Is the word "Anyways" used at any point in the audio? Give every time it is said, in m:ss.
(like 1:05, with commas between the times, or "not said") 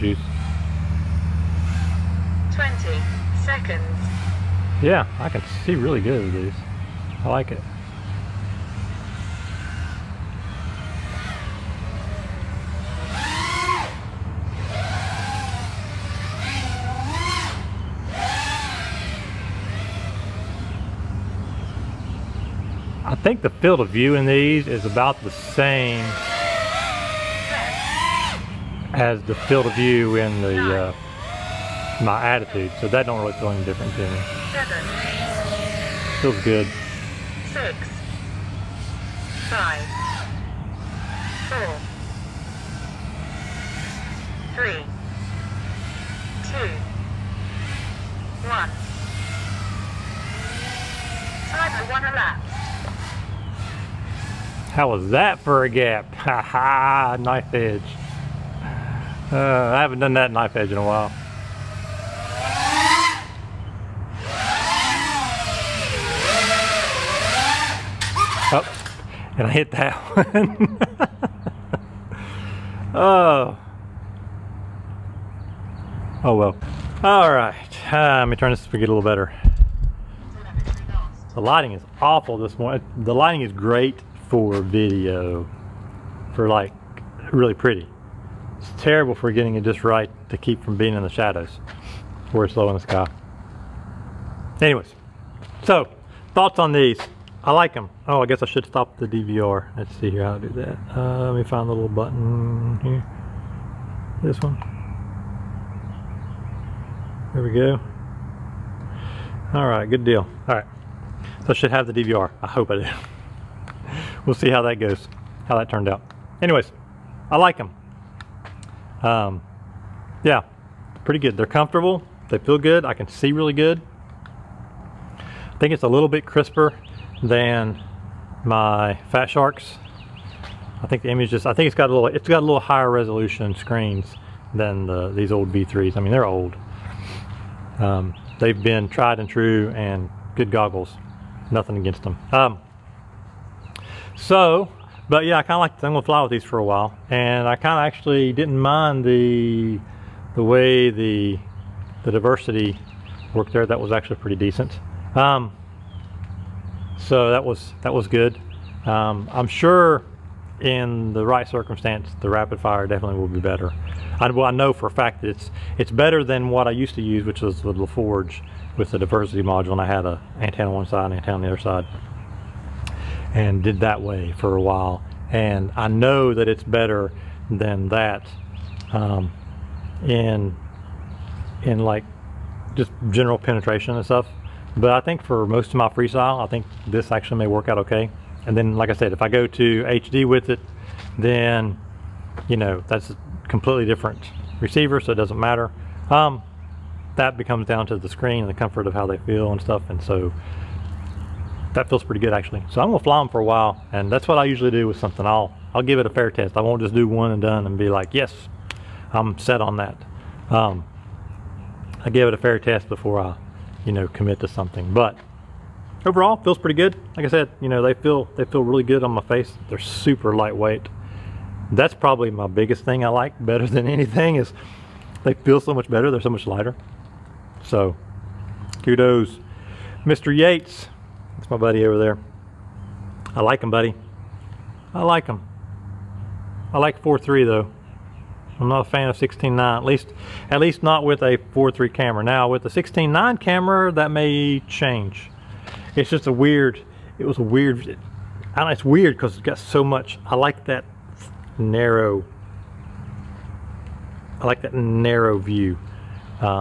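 1:34, 1:56.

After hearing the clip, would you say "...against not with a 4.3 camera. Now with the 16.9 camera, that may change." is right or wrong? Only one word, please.
wrong.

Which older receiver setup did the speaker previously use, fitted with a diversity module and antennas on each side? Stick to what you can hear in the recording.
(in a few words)
LaForge.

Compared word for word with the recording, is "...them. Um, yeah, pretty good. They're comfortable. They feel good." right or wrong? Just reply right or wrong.
right.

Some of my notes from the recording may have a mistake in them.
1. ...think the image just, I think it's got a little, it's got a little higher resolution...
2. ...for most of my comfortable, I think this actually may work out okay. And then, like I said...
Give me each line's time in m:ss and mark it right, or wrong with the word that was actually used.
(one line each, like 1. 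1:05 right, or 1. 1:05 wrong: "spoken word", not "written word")
1. 2:10 right
2. 3:05 wrong: "freestyle", not "comfortable".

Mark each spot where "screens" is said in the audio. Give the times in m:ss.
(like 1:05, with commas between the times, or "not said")
2:13, 3:18.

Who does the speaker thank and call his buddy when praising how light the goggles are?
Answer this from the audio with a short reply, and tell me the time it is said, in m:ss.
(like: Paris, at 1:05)
Mr. Yates, at 3:50.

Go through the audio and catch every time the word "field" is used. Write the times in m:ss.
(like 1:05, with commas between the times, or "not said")
0:23, 0:29.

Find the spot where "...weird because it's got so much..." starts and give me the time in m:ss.
4:08.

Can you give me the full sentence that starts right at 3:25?
I'll, I'll give it a fair test.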